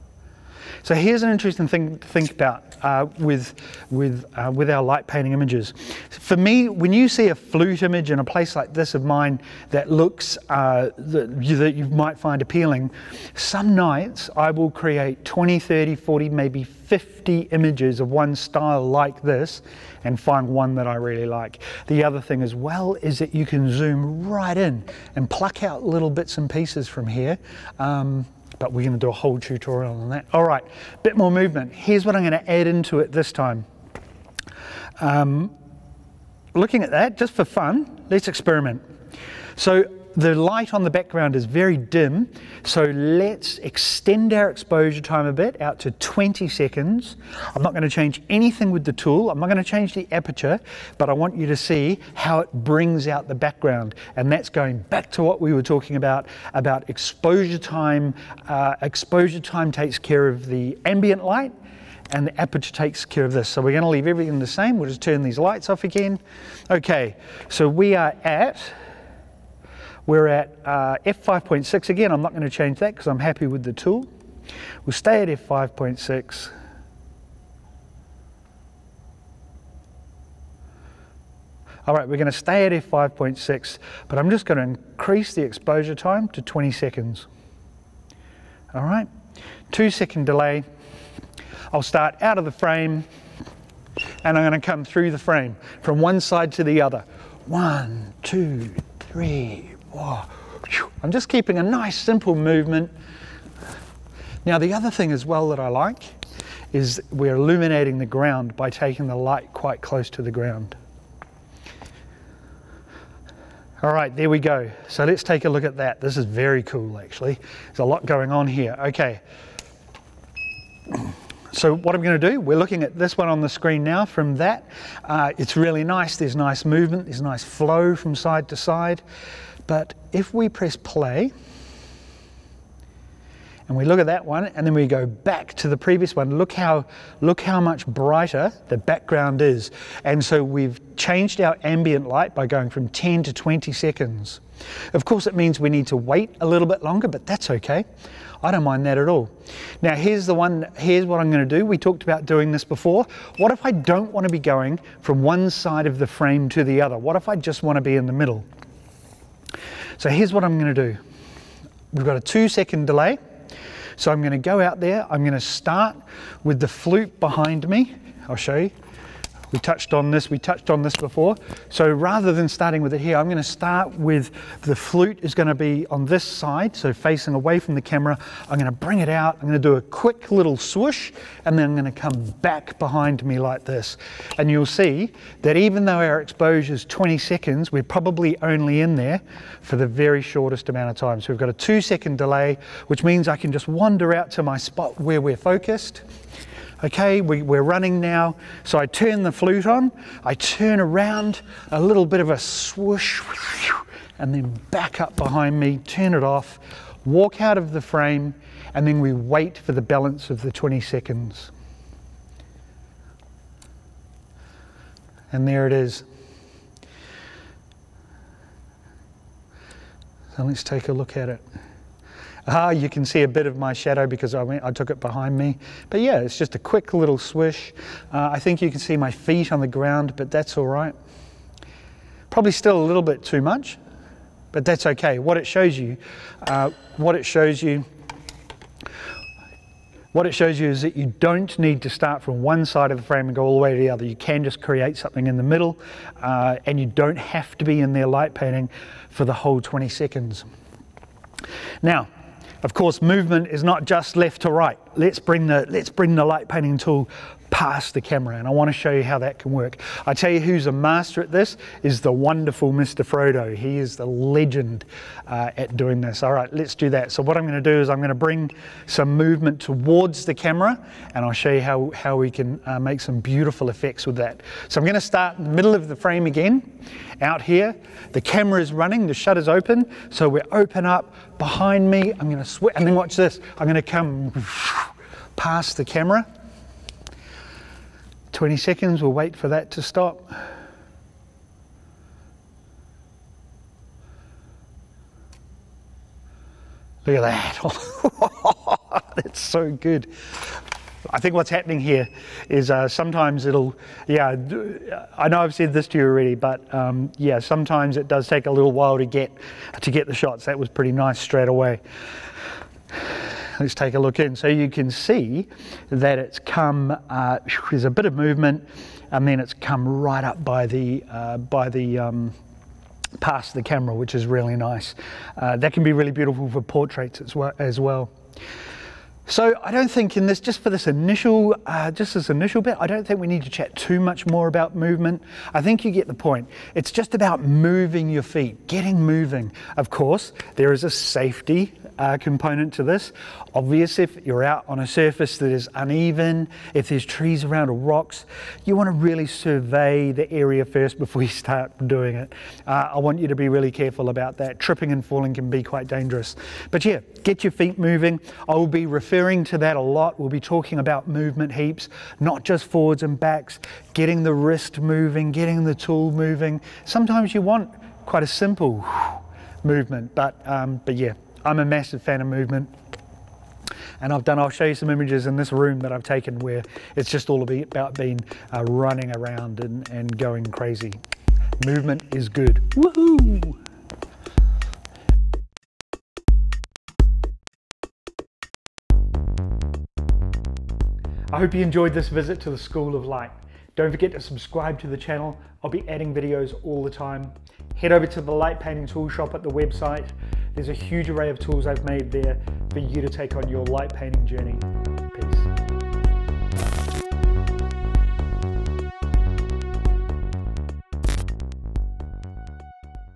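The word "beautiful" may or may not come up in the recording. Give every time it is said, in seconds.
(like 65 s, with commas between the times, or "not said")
273 s, 326 s.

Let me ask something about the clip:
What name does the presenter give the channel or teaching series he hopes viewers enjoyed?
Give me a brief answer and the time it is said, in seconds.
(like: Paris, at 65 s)
School of Light, at 392 s.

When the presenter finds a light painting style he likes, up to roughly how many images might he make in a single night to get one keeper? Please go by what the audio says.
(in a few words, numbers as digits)
50.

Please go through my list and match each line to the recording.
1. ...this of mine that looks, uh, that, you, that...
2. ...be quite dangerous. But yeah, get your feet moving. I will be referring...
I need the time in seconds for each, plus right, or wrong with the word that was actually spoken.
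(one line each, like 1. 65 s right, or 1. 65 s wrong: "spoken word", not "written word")
1. 8 s right
2. 355 s right.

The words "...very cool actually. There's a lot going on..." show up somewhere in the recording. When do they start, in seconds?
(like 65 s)
116 s.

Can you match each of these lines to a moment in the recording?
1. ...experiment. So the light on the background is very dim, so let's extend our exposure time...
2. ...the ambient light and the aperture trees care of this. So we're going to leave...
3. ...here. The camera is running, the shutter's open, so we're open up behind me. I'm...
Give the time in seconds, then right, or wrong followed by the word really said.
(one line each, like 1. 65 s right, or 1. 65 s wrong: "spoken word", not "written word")
1. 38 s right
2. 60 s wrong: "takes", not "trees"
3. 277 s right.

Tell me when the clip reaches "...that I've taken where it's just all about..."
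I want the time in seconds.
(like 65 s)
375 s.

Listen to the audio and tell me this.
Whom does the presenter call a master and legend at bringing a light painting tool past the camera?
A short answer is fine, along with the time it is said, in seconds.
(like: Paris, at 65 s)
Mr. Frodo, at 262 s.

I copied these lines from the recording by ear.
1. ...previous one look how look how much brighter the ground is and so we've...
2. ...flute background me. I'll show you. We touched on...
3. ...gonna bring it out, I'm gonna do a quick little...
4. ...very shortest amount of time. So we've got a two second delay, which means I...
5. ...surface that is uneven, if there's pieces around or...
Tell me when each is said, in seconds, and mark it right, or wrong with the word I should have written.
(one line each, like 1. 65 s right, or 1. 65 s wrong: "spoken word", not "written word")
1. 135 s wrong: "background", not "ground"
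2. 166 s wrong: "behind", not "background"
3. 178 s right
4. 189 s right
5. 344 s wrong: "trees", not "pieces".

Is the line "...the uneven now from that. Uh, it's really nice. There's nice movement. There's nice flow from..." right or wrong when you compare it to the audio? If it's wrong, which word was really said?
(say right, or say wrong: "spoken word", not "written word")
wrong: "screen", not "uneven".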